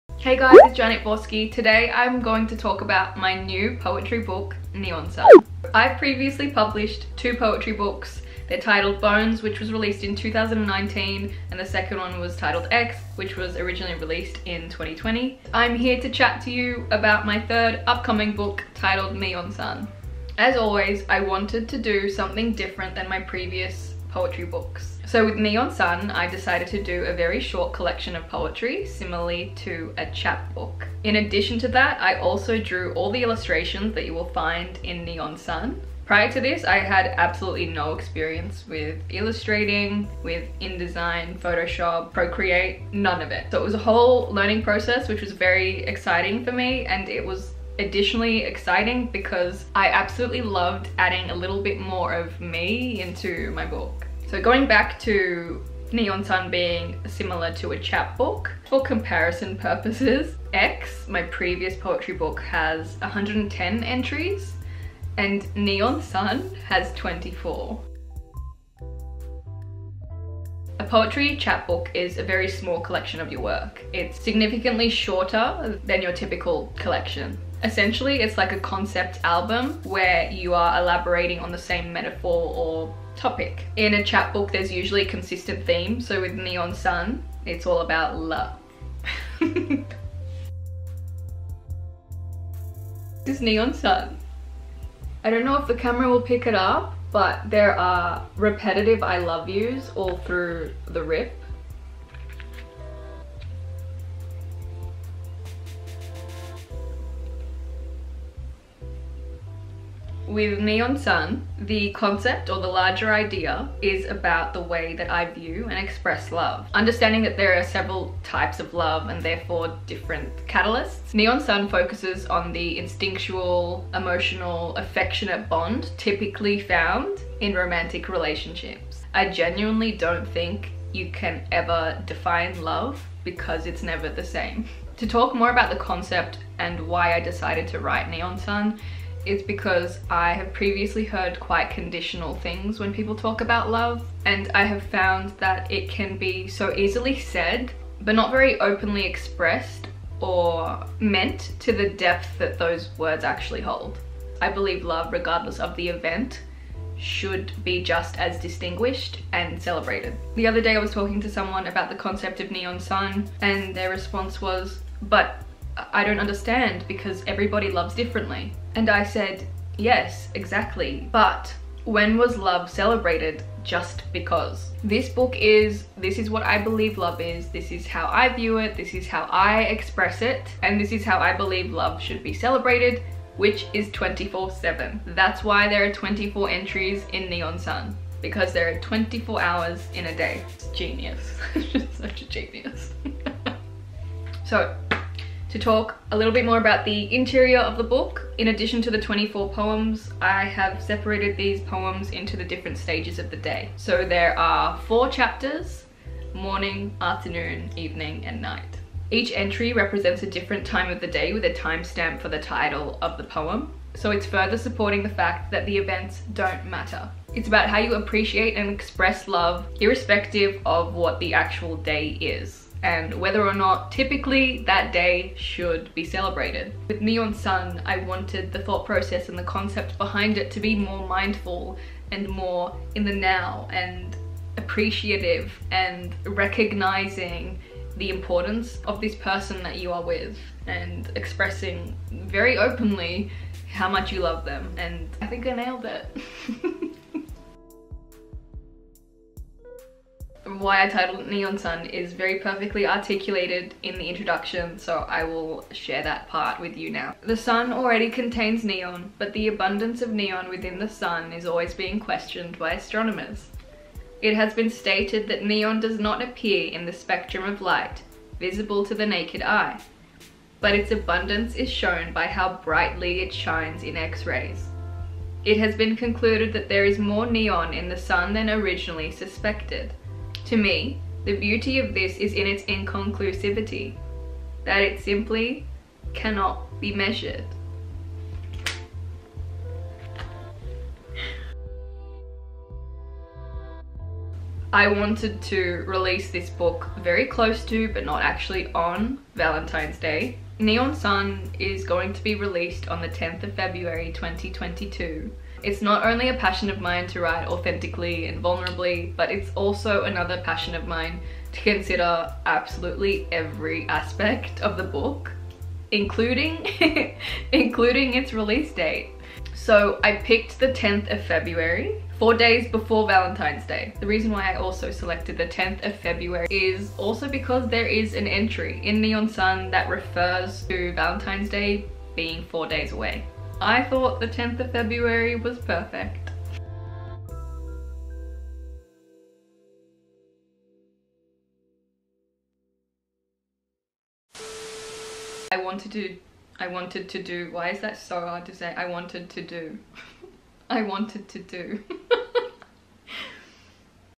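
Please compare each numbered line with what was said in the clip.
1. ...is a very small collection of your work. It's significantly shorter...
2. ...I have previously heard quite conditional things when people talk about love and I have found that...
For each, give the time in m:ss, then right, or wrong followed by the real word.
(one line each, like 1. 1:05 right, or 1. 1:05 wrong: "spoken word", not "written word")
1. 1:11 right
2. 2:20 right.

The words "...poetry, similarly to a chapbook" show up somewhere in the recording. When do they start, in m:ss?
0:28.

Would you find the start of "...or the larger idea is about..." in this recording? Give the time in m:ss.
1:52.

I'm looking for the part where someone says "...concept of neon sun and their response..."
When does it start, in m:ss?
2:41.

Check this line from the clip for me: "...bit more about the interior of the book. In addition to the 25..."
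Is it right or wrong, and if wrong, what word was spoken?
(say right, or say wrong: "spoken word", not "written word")
wrong: "24", not "25".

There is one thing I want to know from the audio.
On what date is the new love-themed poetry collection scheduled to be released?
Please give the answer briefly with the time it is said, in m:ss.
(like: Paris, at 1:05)
10 February 2022, at 5:03.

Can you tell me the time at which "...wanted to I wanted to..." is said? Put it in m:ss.
5:45.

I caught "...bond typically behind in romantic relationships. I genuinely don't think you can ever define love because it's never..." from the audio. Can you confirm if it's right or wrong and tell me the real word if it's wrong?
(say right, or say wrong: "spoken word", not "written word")
wrong: "found", not "behind".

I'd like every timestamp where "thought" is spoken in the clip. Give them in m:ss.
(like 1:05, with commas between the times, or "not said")
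3:48, 5:33.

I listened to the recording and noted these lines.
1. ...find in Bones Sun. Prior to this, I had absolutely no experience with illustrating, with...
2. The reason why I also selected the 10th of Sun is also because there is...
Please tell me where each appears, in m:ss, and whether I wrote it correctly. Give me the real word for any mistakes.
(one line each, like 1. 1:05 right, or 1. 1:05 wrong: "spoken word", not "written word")
1. 0:34 wrong: "Neon", not "Bones"
2. 5:23 wrong: "February", not "Sun".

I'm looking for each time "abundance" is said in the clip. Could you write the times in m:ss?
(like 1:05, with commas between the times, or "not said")
4:19, 4:30.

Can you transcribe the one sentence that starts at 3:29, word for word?
Each entry represents a different time of the day with a timestamp for the title of the poem.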